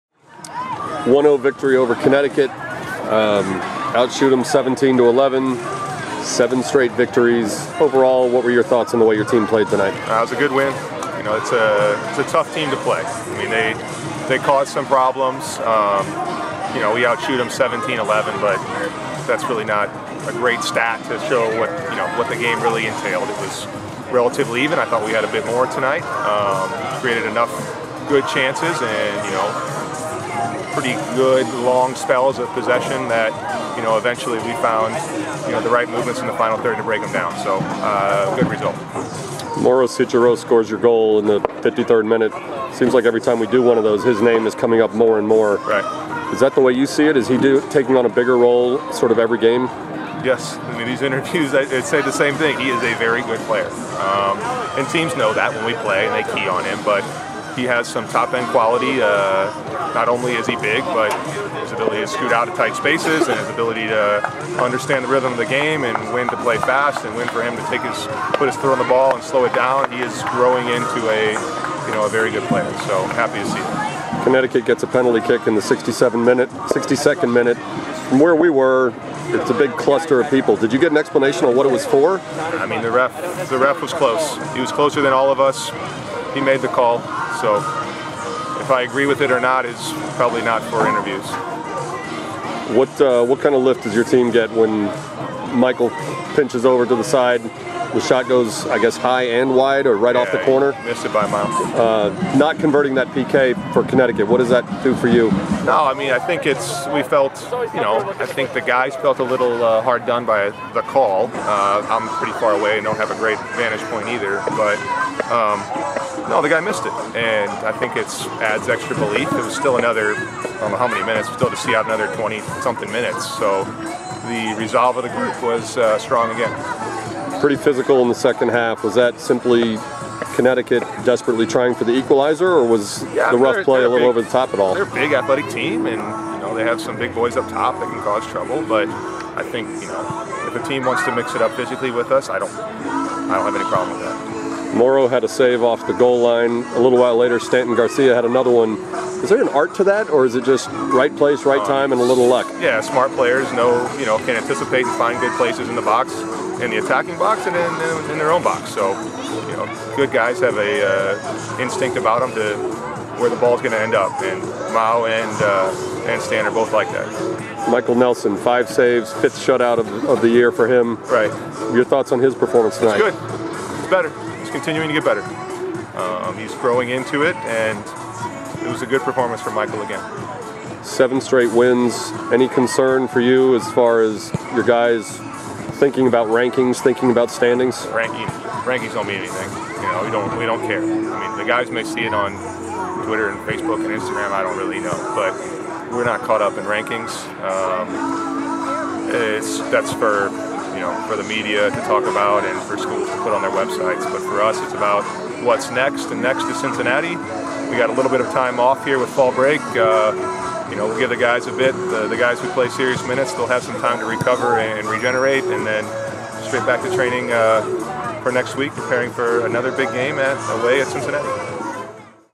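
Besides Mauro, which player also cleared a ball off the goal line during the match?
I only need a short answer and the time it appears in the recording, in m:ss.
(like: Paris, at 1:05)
Stanton Garcia, at 2:27.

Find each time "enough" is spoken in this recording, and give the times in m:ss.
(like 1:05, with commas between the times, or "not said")
0:27.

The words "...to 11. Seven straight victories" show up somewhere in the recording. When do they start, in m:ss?
0:04.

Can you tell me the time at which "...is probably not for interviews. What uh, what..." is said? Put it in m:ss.
1:29.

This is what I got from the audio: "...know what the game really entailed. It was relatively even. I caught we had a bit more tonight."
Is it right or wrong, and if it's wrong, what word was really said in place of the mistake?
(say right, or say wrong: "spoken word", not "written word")
wrong: "thought", not "caught".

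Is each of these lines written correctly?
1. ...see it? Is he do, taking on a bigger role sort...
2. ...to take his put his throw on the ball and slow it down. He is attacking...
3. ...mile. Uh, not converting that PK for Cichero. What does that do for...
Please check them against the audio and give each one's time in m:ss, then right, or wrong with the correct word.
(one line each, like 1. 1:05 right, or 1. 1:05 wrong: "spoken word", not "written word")
1. 0:46 right
2. 1:07 wrong: "growing", not "attacking"
3. 1:41 wrong: "Connecticut", not "Cichero".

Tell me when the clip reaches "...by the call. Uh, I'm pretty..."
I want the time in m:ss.
1:50.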